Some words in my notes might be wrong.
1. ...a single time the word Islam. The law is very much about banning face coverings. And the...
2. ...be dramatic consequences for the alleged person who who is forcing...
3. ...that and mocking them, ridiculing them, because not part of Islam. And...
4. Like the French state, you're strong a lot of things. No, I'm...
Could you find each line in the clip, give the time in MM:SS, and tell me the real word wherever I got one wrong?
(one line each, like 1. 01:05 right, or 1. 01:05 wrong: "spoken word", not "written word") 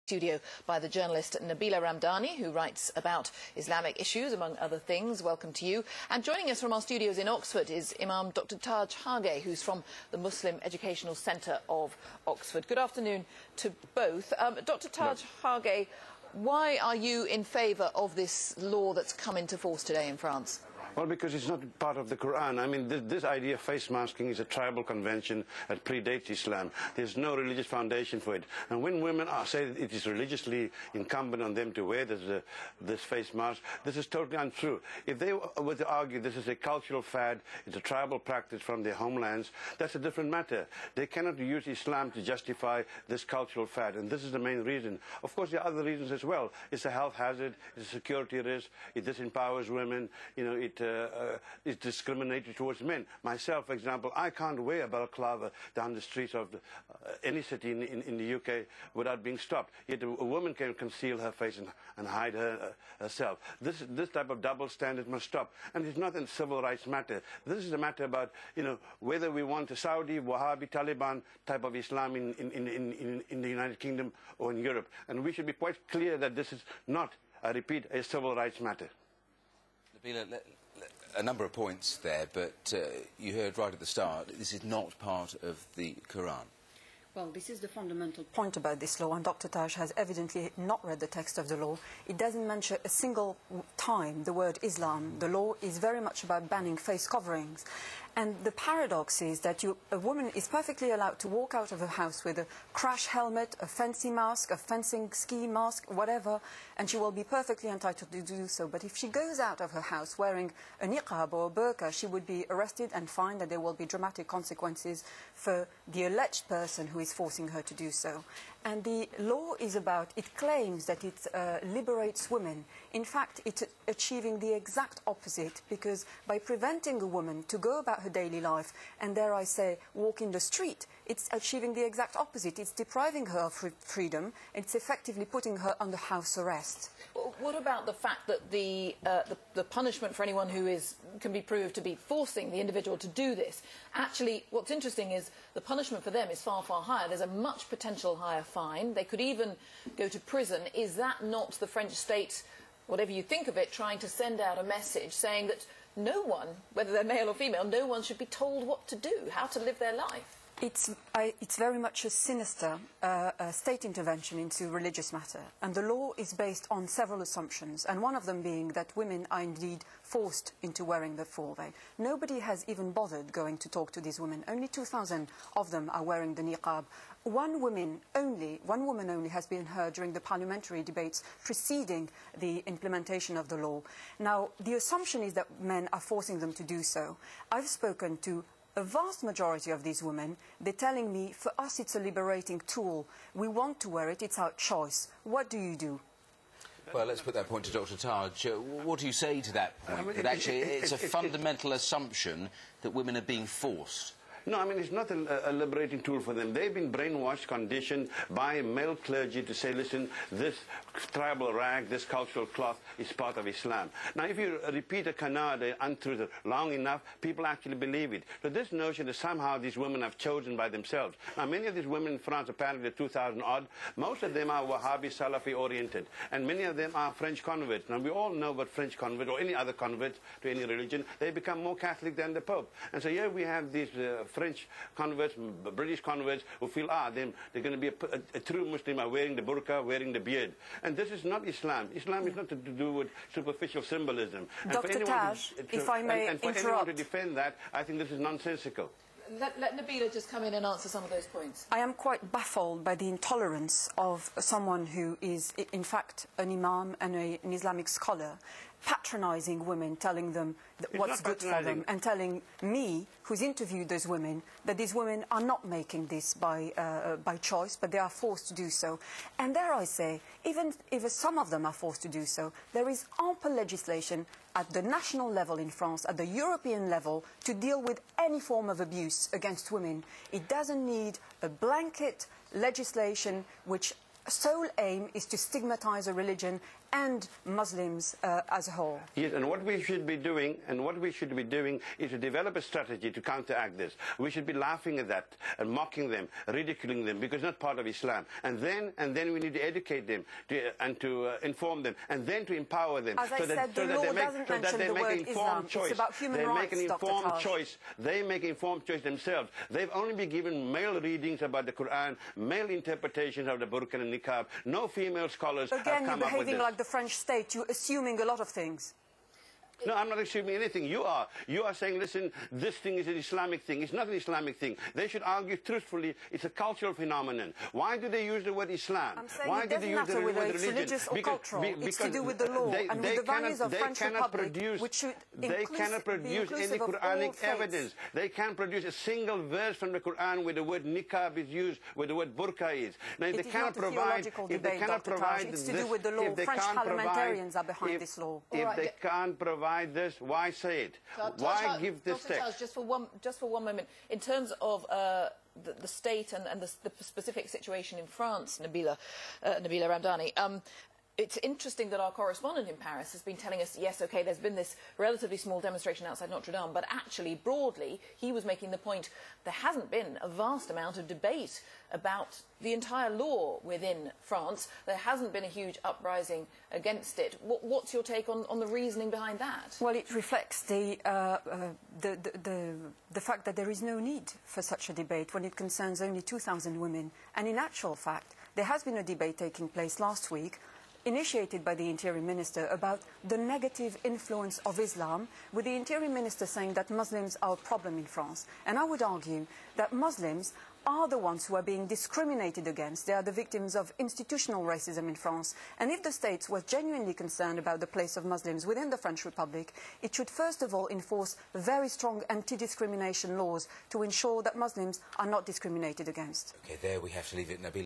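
1. 01:32 right
2. 01:53 right
3. 04:55 right
4. 05:16 wrong: "assuming", not "strong".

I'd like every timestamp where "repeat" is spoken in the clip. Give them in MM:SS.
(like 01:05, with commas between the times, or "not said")
01:17, 03:34.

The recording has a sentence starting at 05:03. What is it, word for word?
As so I that, said, so law make, doesn't so the word Islam.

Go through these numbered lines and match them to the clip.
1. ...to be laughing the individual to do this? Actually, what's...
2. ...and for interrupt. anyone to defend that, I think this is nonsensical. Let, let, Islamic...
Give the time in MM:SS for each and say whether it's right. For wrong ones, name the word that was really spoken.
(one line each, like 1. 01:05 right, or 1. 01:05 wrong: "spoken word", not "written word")
1. 02:21 wrong: "forcing", not "laughing"
2. 04:06 wrong: "Nabila", not "Islamic".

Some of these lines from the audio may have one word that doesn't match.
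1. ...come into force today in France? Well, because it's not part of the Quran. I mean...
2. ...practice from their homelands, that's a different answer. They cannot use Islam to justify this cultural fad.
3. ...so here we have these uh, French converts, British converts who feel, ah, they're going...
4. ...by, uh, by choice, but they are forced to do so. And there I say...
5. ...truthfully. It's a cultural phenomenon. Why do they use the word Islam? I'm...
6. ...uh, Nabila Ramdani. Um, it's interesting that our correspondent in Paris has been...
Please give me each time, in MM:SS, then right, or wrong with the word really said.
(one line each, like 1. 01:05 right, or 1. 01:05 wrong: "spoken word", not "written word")
1. 00:19 right
2. 00:38 wrong: "matter", not "answer"
3. 03:53 right
4. 04:26 right
5. 05:25 right
6. 05:59 right.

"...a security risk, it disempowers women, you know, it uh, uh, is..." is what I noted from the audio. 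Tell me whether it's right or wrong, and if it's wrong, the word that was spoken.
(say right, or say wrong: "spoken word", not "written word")
right.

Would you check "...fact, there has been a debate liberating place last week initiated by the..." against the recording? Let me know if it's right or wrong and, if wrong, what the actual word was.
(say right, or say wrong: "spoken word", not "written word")
wrong: "taking", not "liberating".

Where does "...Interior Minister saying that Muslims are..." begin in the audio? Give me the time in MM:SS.
06:35.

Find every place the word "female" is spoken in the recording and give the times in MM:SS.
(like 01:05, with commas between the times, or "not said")
02:37, 05:14.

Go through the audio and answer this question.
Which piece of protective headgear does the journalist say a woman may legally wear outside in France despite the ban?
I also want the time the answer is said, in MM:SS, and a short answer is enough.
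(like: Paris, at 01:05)
crash helmet, at 01:42.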